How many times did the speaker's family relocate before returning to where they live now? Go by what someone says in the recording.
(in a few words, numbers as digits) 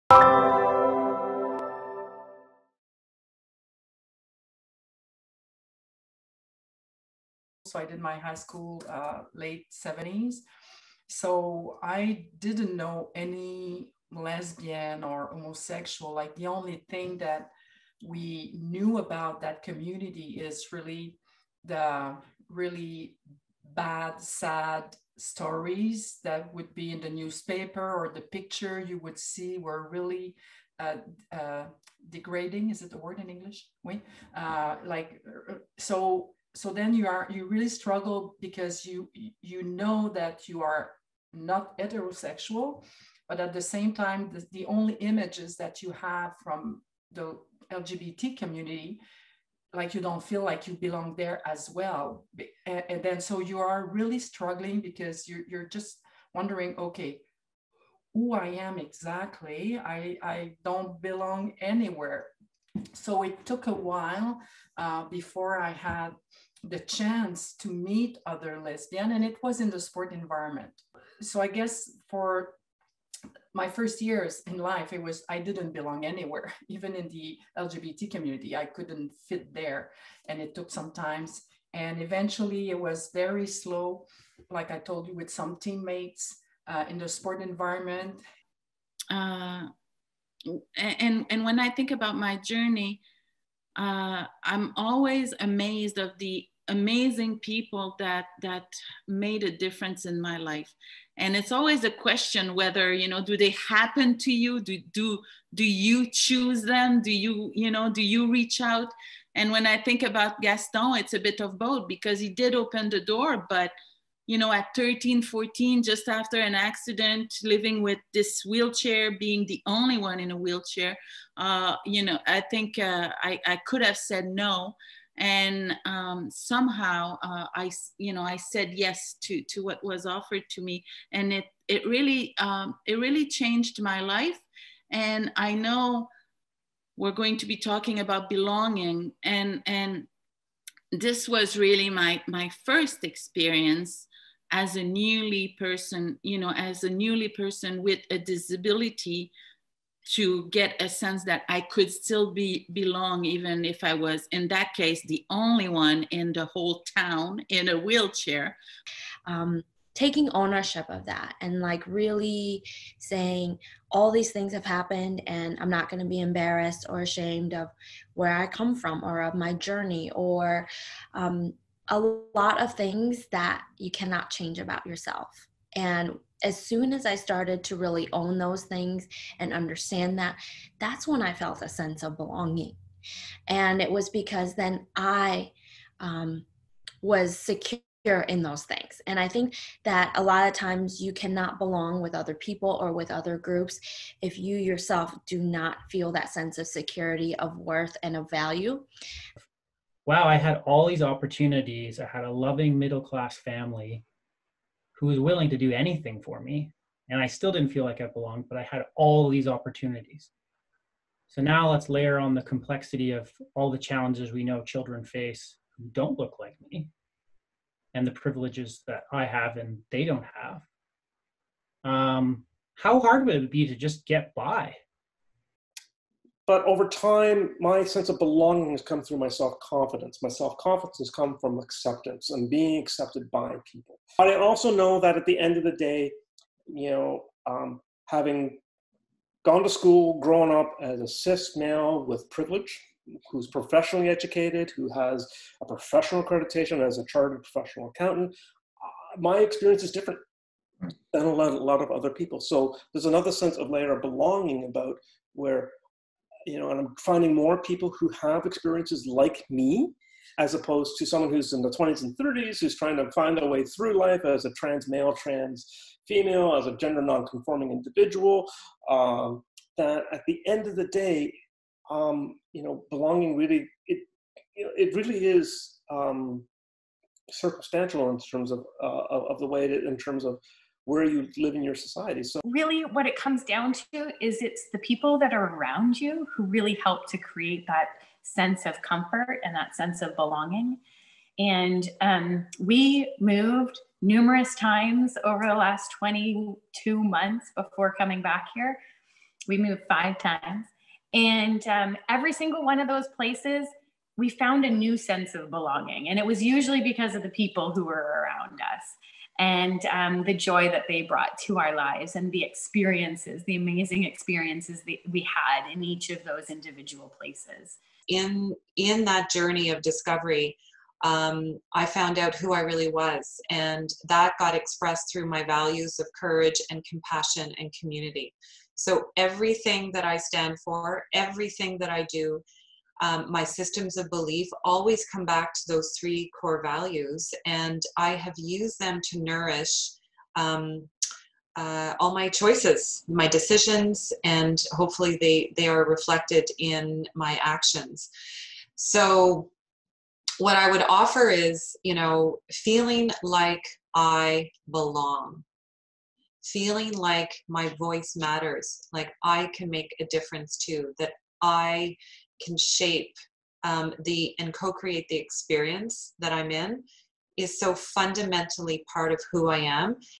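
5 times.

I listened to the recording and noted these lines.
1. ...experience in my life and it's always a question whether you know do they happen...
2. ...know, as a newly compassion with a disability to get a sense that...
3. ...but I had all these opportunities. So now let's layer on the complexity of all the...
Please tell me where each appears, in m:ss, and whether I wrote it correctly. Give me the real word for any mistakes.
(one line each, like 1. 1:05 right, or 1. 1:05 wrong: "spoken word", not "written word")
1. 1:39 wrong: "difference", not "experience"
2. 2:26 wrong: "person", not "compassion"
3. 3:28 right.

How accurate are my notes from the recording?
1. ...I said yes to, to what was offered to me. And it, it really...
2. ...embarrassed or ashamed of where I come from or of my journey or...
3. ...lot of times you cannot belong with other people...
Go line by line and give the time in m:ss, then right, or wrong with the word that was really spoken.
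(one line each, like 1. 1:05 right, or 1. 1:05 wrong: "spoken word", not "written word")
1. 2:08 right
2. 2:46 right
3. 3:10 right.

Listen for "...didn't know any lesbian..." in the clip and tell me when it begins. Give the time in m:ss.
0:12.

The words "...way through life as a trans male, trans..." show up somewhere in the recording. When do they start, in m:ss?
4:23.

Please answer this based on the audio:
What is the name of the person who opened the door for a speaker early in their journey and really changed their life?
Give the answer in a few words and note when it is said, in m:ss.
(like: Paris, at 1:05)
Gaston, at 1:50.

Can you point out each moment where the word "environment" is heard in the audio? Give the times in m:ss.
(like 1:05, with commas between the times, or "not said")
1:10, 1:27.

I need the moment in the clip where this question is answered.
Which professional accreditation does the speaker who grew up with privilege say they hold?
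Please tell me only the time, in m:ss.
4:07.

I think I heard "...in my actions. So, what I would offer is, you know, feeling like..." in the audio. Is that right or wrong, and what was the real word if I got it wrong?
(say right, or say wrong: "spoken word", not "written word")
right.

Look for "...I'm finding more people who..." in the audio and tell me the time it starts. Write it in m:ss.
4:16.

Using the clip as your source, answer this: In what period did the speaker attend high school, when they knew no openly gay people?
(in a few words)
late 70s.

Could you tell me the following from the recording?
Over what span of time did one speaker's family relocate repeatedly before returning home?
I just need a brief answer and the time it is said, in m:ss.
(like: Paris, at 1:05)
22 months, at 4:55.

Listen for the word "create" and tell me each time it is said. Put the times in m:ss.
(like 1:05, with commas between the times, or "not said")
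4:47, 6:04.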